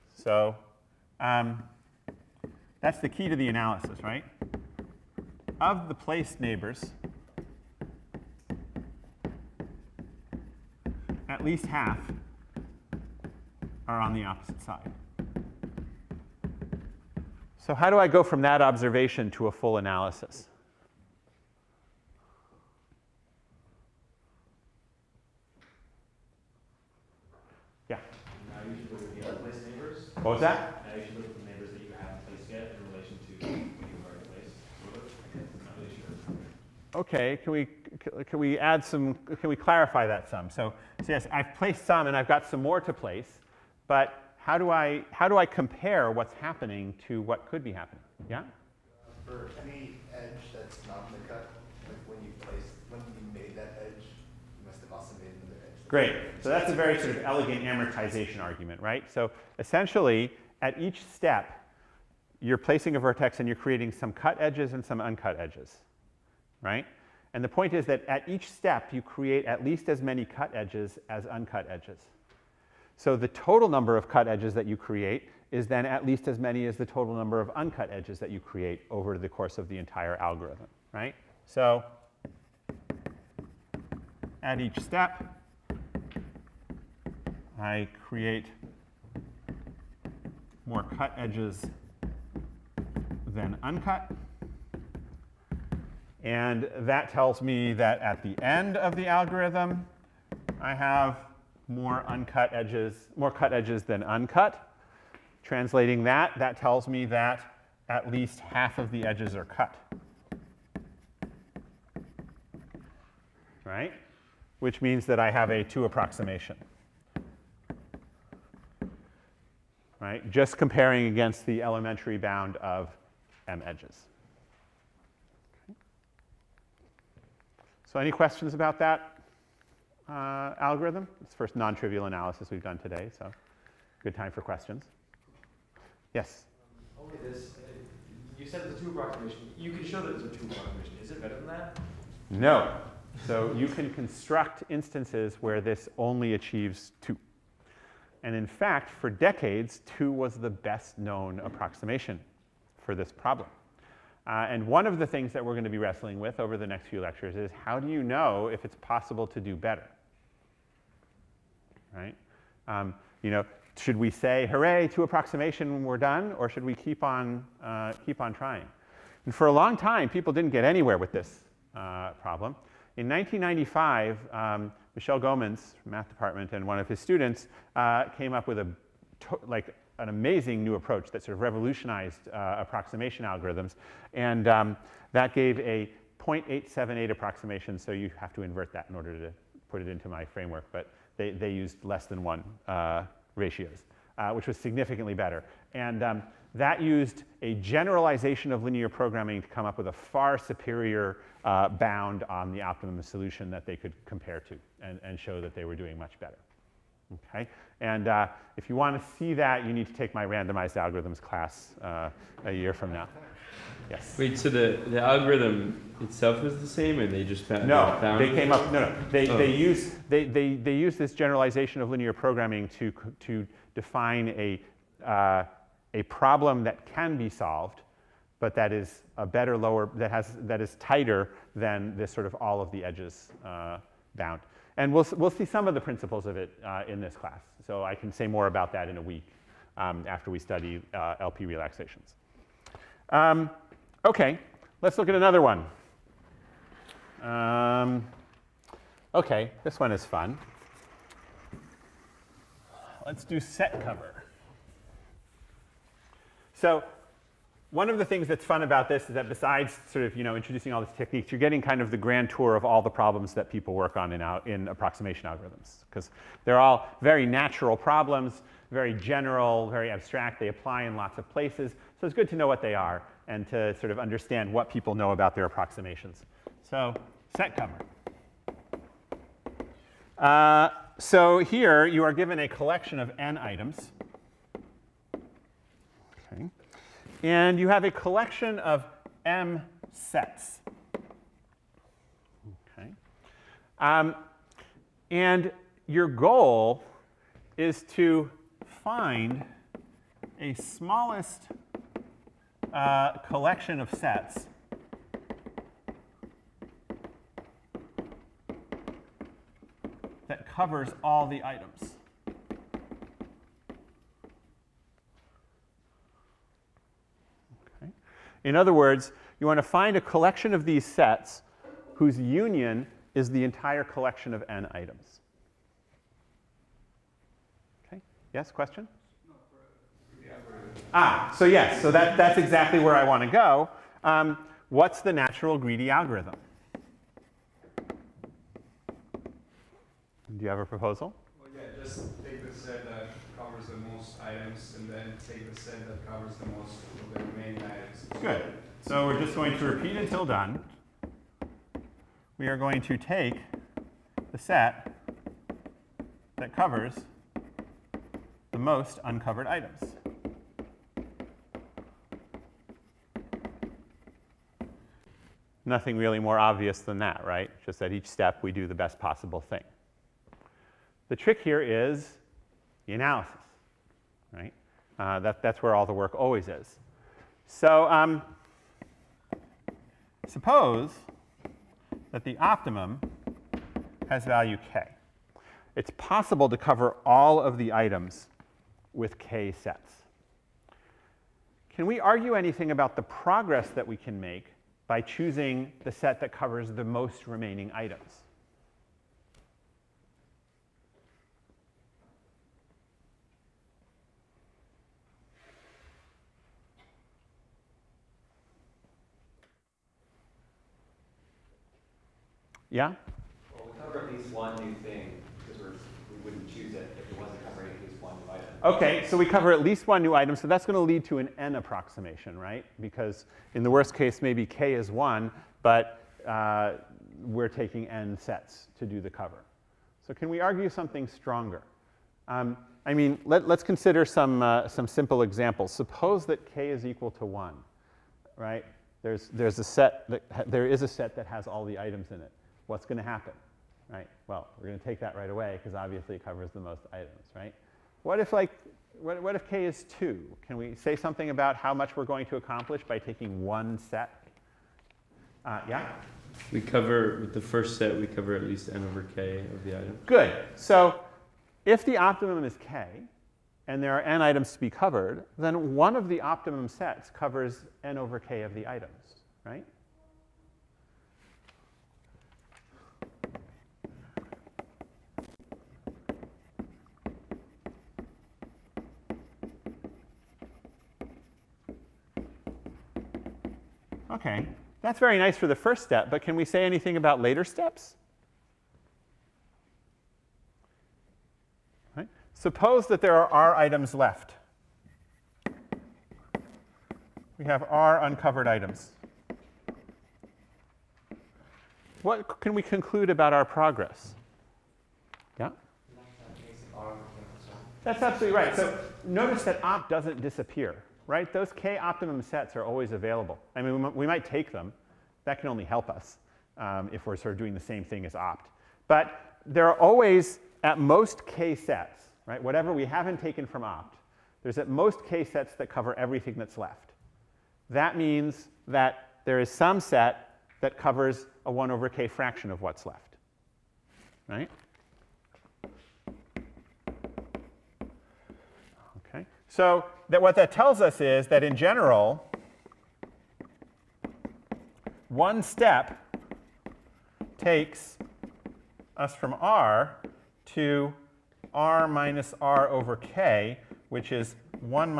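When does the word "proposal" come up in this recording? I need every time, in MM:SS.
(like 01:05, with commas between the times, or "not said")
05:40.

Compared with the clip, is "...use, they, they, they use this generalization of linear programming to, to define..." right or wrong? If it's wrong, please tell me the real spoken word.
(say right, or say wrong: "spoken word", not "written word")
right.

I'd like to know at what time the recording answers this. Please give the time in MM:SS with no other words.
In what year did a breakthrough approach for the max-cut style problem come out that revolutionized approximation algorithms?
02:53.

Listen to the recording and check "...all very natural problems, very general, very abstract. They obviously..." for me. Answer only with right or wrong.
wrong.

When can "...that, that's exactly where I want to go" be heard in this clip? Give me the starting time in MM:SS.
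05:31.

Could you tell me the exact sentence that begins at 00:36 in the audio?
Okay, can we, can we add some, can we clarify that some?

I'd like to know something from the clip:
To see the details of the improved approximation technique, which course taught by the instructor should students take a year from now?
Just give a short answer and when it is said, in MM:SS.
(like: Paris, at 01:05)
randomized algorithms, at 03:30.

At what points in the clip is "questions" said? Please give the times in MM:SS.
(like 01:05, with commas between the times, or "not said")
02:08, 02:14, 05:28.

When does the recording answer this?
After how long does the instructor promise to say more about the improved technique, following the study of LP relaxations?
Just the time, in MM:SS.
03:58.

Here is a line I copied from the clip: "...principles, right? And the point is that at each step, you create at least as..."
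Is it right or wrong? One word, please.
wrong.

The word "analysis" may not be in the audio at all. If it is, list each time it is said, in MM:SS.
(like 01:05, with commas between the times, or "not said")
00:03, 00:19, 02:12, 06:12.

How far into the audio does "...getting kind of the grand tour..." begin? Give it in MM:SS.
04:21.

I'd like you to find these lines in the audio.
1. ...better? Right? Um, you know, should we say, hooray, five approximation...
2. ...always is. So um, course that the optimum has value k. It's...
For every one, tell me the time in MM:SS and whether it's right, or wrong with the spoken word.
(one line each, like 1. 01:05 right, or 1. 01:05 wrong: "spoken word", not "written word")
1. 02:39 wrong: "two", not "five"
2. 06:16 wrong: "suppose", not "course".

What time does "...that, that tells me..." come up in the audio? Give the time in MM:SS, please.
01:46.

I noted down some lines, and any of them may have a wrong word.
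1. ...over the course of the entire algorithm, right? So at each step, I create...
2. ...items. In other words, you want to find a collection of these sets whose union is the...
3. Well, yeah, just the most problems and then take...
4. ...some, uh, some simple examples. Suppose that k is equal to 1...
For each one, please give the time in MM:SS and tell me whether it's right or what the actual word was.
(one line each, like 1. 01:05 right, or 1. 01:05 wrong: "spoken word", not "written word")
1. 01:18 right
2. 05:11 right
3. 05:41 wrong: "items", not "problems"
4. 07:14 right.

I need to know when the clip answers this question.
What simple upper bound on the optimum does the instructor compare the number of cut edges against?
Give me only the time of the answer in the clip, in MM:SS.
02:03.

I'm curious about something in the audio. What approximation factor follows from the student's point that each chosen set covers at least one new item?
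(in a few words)
n approximation.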